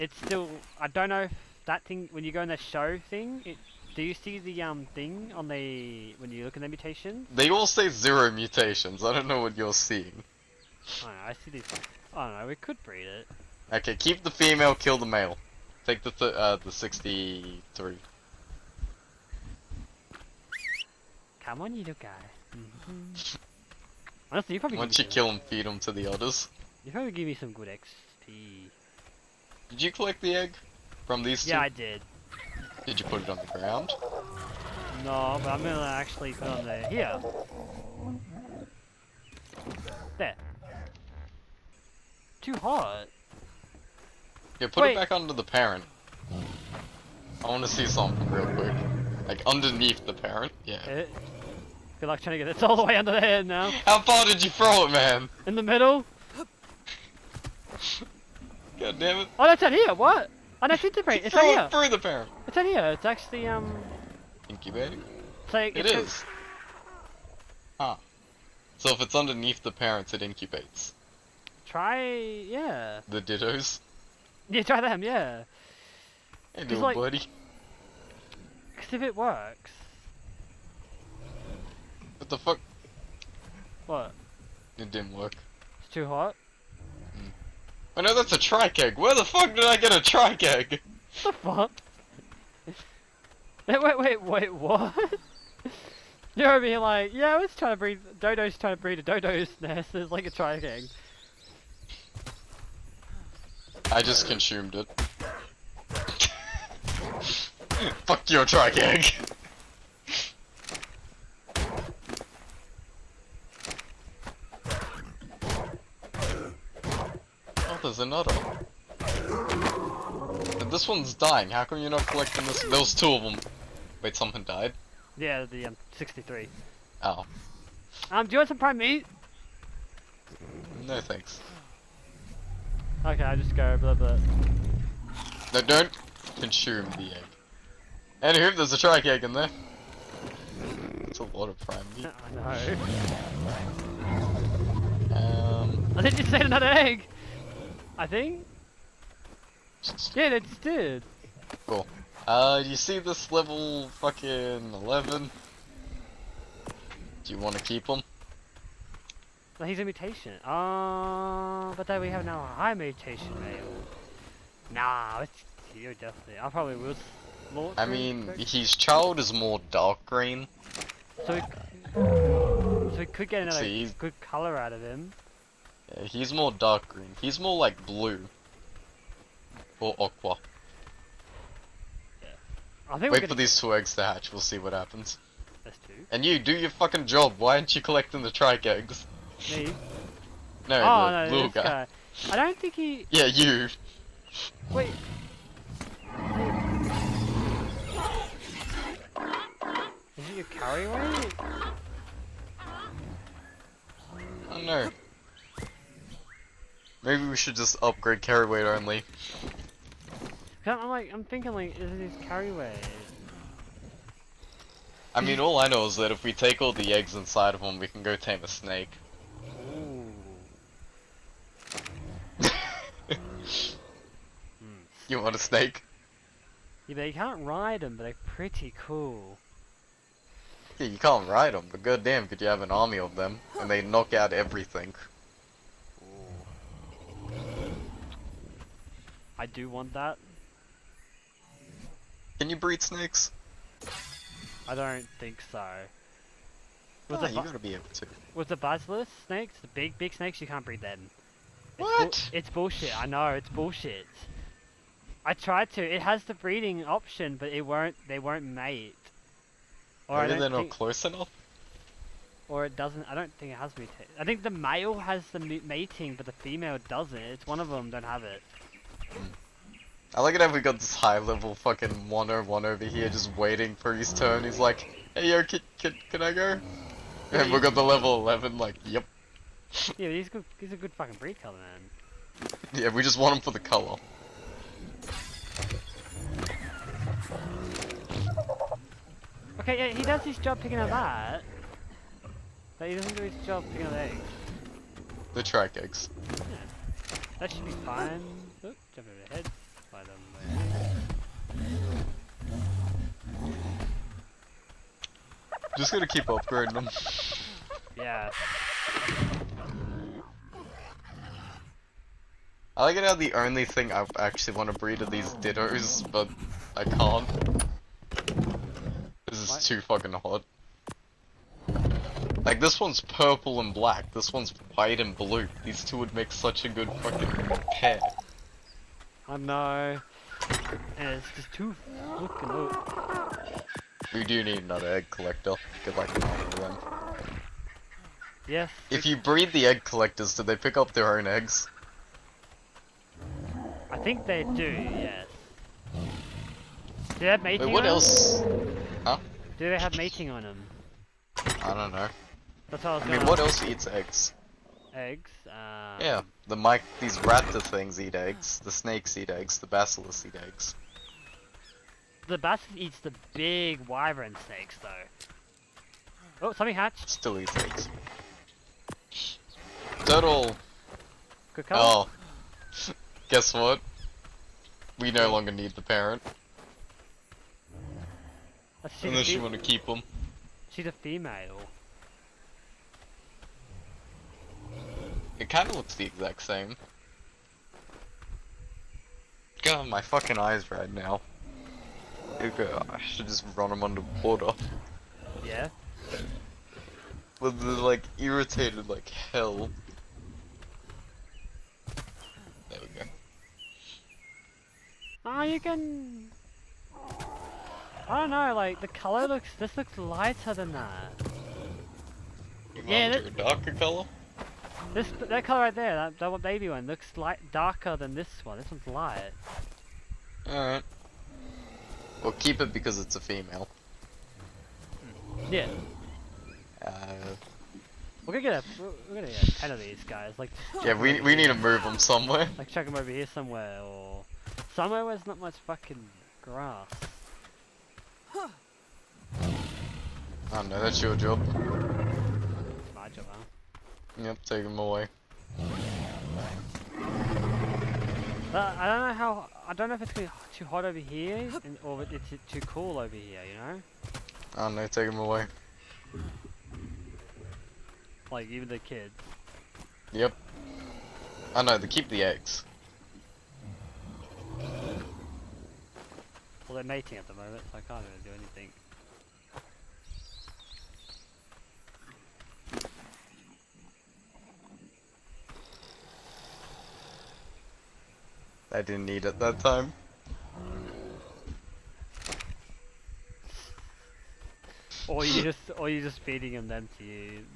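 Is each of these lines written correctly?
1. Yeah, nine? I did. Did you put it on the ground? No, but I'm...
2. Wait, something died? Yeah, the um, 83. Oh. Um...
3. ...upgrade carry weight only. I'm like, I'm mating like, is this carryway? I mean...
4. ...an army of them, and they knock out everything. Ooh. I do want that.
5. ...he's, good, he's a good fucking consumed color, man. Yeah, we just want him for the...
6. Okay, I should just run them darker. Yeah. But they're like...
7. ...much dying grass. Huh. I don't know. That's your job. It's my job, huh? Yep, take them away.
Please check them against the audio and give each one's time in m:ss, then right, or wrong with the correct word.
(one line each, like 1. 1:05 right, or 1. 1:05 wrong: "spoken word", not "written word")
1. 0:31 wrong: "two", not "nine"
2. 2:04 wrong: "63", not "83"
3. 3:27 wrong: "thinking", not "mating"
4. 3:52 right
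5. 4:40 wrong: "breed", not "consumed"
6. 6:32 wrong: "underwater", not "darker"
7. 7:15 wrong: "fucking", not "dying".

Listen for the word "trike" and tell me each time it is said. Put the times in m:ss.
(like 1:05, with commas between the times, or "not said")
1:28, 2:18, 3:08.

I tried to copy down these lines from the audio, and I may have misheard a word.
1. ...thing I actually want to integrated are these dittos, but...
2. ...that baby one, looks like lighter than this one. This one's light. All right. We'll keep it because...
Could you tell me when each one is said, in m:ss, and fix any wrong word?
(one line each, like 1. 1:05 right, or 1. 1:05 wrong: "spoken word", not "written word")
1. 5:13 wrong: "breed", not "integrated"
2. 6:56 wrong: "darker", not "lighter".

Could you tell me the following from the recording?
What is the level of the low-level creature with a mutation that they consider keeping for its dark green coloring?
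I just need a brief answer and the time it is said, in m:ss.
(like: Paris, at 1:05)
11, at 2:33.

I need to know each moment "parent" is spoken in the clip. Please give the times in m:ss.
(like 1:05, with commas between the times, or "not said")
0:45, 0:50, 1:01, 1:09, 6:15.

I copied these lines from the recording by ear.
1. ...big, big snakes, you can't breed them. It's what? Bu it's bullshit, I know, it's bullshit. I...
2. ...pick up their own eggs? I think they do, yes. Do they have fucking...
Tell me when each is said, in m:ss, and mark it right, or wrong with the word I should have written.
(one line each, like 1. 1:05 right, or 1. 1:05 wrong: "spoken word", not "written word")
1. 4:09 right
2. 5:40 wrong: "mating", not "fucking".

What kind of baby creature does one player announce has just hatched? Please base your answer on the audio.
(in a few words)
Turtle.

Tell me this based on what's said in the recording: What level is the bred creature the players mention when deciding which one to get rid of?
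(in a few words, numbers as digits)
63.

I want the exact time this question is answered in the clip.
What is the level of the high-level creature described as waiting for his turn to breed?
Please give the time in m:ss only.
4:32.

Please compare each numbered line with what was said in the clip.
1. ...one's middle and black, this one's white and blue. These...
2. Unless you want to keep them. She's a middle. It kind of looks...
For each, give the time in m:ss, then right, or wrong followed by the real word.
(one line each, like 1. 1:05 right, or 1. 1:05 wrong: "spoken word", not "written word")
1. 5:22 wrong: "purple", not "middle"
2. 6:19 wrong: "female", not "middle".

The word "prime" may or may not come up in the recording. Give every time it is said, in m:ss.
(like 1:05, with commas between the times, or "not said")
2:08, 2:21.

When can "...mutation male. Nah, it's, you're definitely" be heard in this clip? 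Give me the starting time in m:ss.
2:42.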